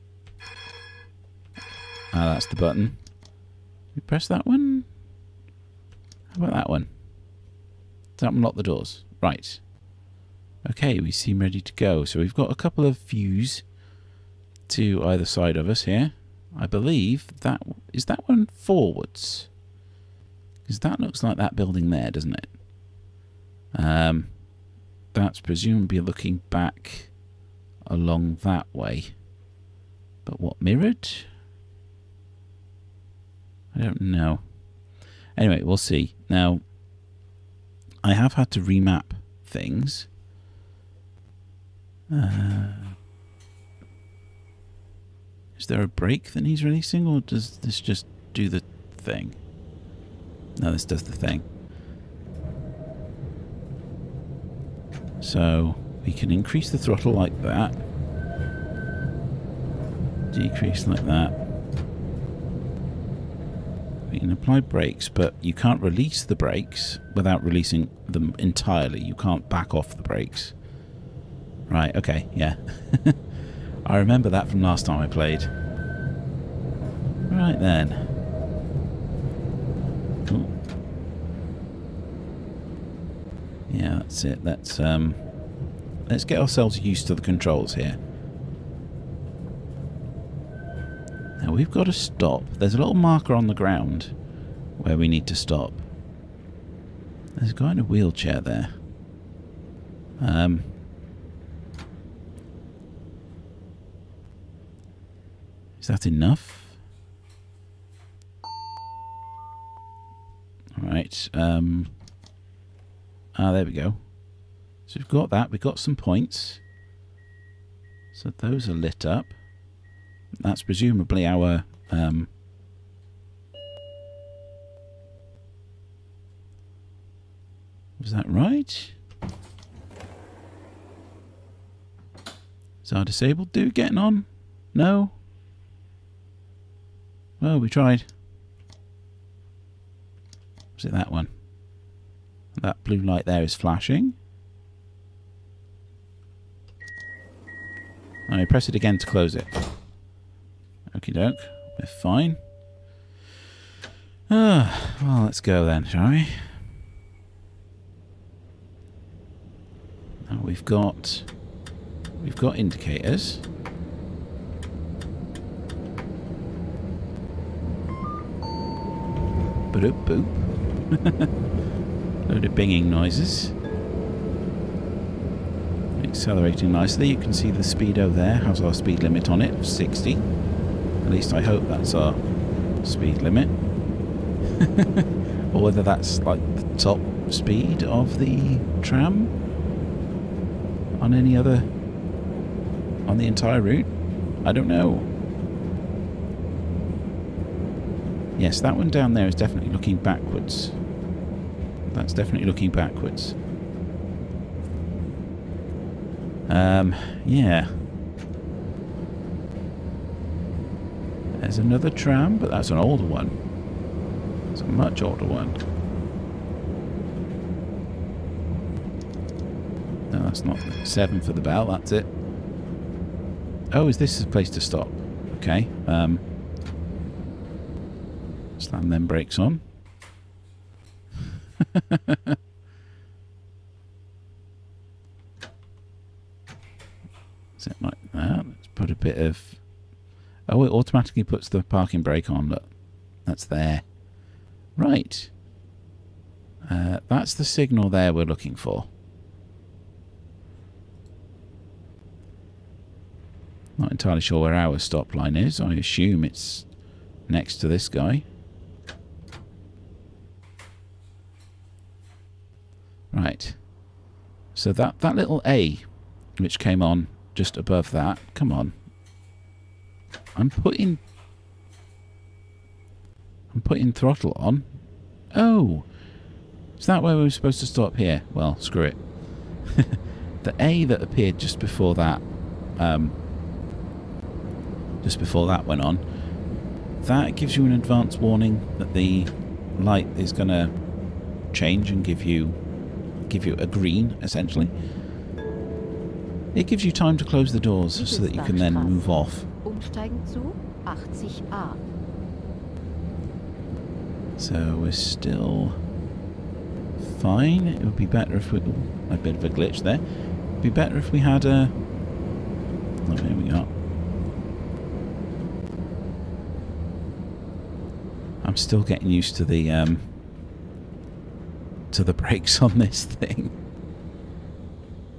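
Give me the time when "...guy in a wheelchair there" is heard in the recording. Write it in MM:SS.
01:37.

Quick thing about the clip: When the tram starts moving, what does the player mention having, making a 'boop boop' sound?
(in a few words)
Indicators.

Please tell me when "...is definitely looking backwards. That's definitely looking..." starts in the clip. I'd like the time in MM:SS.
03:19.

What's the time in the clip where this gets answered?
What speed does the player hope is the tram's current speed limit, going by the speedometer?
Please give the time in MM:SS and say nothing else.
02:59.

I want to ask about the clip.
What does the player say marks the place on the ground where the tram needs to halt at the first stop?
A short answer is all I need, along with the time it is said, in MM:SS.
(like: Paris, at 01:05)
A little marker, at 01:32.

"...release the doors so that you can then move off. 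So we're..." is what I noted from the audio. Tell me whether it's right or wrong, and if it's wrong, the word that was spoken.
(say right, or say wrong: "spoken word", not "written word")
wrong: "close", not "release".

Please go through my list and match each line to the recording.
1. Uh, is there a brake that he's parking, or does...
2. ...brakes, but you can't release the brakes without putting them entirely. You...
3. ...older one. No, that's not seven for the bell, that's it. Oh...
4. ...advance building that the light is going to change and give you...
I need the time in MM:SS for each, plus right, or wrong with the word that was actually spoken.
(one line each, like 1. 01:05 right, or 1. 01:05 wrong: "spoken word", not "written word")
1. 00:42 wrong: "releasing", not "parking"
2. 01:04 wrong: "releasing", not "putting"
3. 03:35 right
4. 04:47 wrong: "warning", not "building".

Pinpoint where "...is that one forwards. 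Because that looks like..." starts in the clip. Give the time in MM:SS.
00:17.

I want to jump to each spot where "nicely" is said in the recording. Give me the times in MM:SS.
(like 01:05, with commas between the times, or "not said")
02:56.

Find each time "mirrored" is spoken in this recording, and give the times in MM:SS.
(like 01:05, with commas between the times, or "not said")
00:30.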